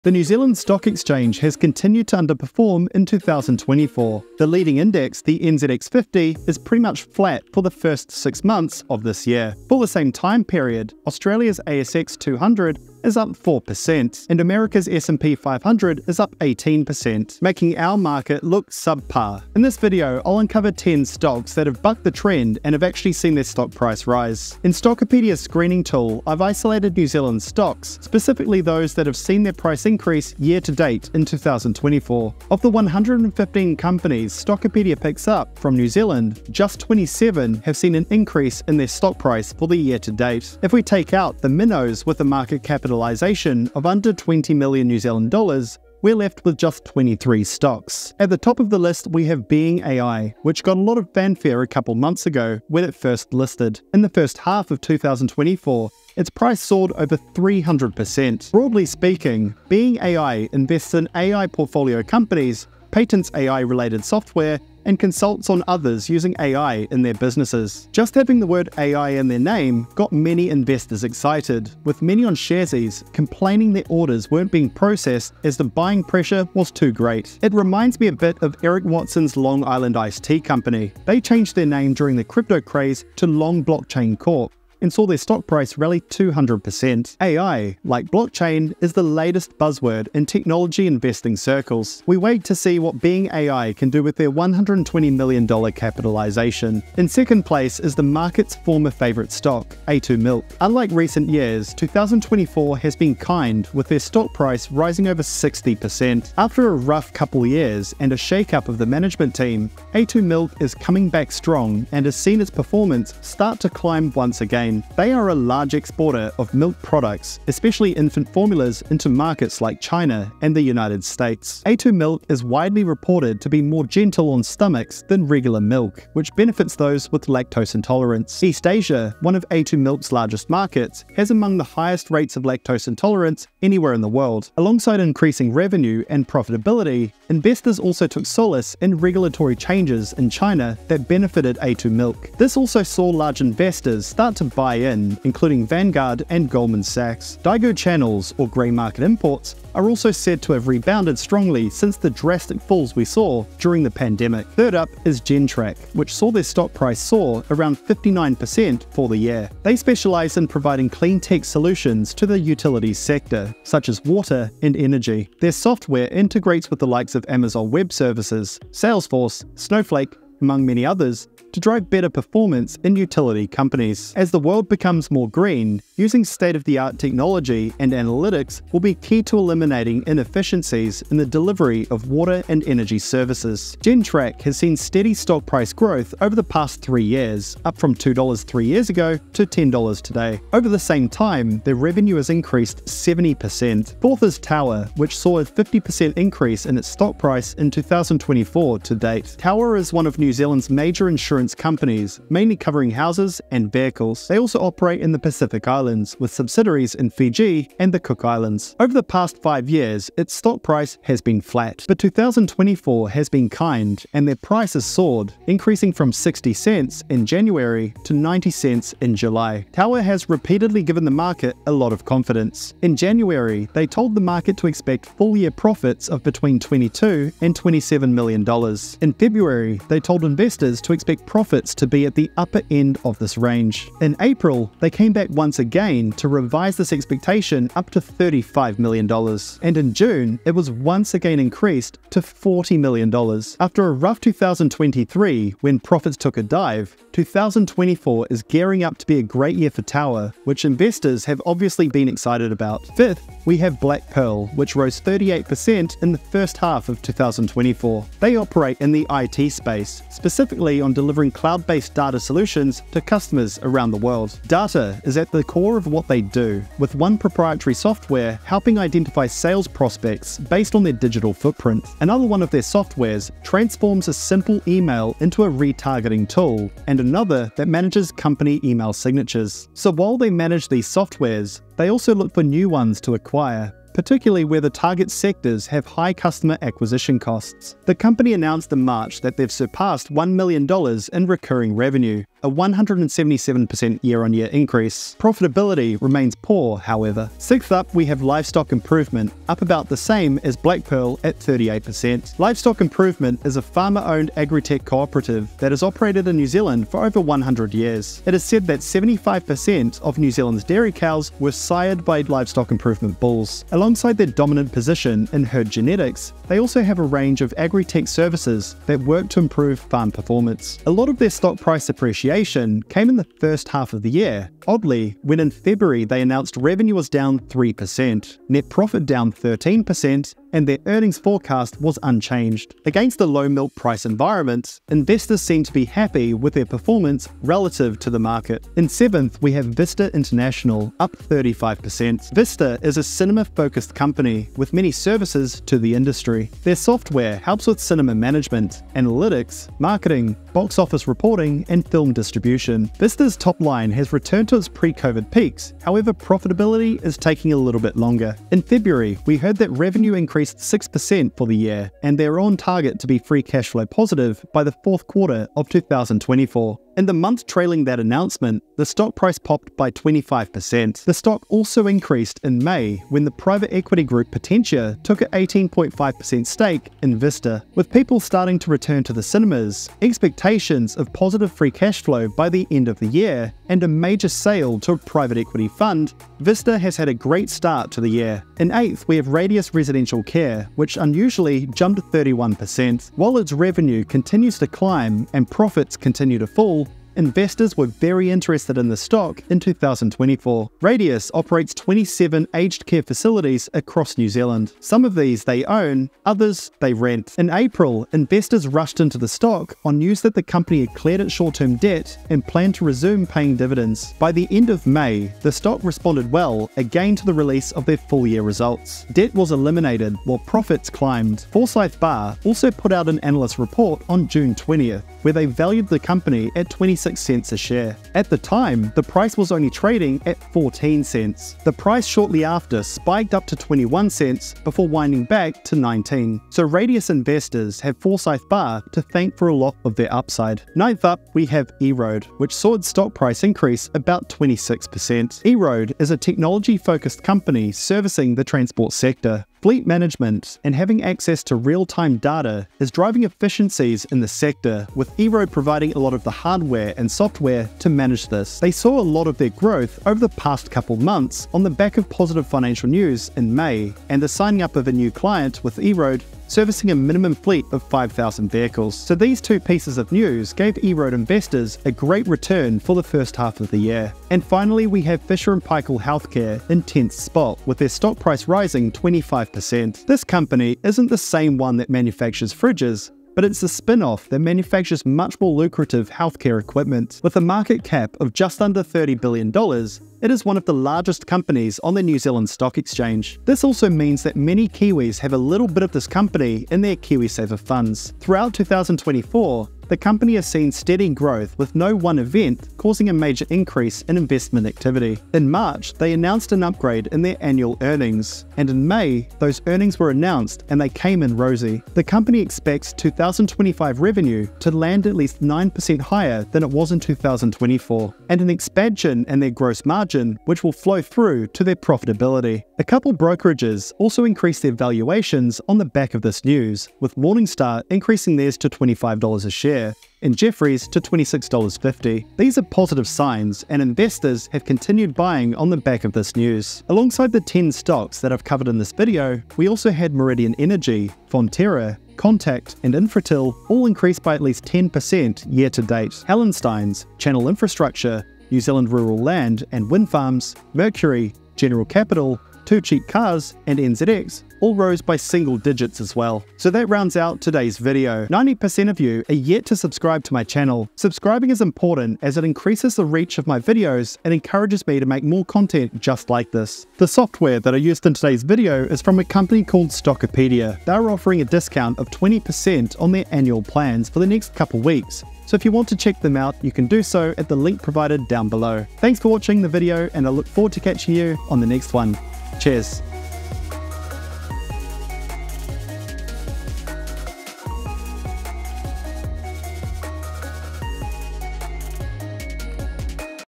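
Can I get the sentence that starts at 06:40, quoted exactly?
Radius operates 27 aged care facilities across New Zealand.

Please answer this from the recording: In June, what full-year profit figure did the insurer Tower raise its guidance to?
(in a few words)
$40 million.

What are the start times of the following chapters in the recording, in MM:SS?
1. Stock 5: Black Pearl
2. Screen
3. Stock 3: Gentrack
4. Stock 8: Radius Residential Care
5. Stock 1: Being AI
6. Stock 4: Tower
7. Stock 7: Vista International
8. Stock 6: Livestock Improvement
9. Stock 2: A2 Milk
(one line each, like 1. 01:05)
1. 04:12
2. 00:24
3. 02:34
4. 06:28
5. 00:48
6. 03:13
7. 05:38
8. 04:57
9. 01:36.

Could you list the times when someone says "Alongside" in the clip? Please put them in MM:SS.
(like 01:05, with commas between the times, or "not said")
02:14, 05:13, 08:56.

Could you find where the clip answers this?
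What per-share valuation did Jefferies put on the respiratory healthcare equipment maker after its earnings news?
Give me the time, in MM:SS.
08:51.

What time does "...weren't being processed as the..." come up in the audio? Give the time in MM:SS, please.
01:14.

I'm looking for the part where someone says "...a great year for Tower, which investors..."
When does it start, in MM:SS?
04:09.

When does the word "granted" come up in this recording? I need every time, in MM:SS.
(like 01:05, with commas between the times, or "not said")
not said.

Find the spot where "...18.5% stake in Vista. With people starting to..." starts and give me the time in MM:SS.
06:15.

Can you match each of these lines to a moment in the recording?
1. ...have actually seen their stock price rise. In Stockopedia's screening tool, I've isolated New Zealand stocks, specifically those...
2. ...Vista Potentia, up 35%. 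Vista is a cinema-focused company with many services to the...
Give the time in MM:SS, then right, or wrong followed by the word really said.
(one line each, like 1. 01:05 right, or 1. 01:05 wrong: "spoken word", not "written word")
1. 00:22 right
2. 05:39 wrong: "International", not "Potentia".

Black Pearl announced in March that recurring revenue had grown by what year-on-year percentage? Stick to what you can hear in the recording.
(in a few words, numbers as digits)
177%.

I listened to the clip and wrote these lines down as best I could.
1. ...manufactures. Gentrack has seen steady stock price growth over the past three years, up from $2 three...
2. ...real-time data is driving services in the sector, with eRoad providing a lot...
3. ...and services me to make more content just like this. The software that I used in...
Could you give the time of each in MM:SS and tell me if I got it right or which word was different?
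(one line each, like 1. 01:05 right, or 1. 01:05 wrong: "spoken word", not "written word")
1. 03:02 wrong: "services", not "manufactures"
2. 07:31 wrong: "efficiencies", not "services"
3. 09:24 wrong: "encourages", not "services".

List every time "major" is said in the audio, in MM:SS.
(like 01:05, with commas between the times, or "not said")
03:20, 06:23, 08:23.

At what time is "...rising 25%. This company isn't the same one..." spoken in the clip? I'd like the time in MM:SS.
07:58.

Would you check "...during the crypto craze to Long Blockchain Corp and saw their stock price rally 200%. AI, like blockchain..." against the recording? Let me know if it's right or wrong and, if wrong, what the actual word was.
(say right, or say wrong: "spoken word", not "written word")
right.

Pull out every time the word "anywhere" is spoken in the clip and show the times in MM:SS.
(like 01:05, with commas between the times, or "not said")
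02:13.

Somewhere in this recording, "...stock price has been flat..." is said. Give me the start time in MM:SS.
03:30.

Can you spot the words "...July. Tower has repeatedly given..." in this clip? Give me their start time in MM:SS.
03:39.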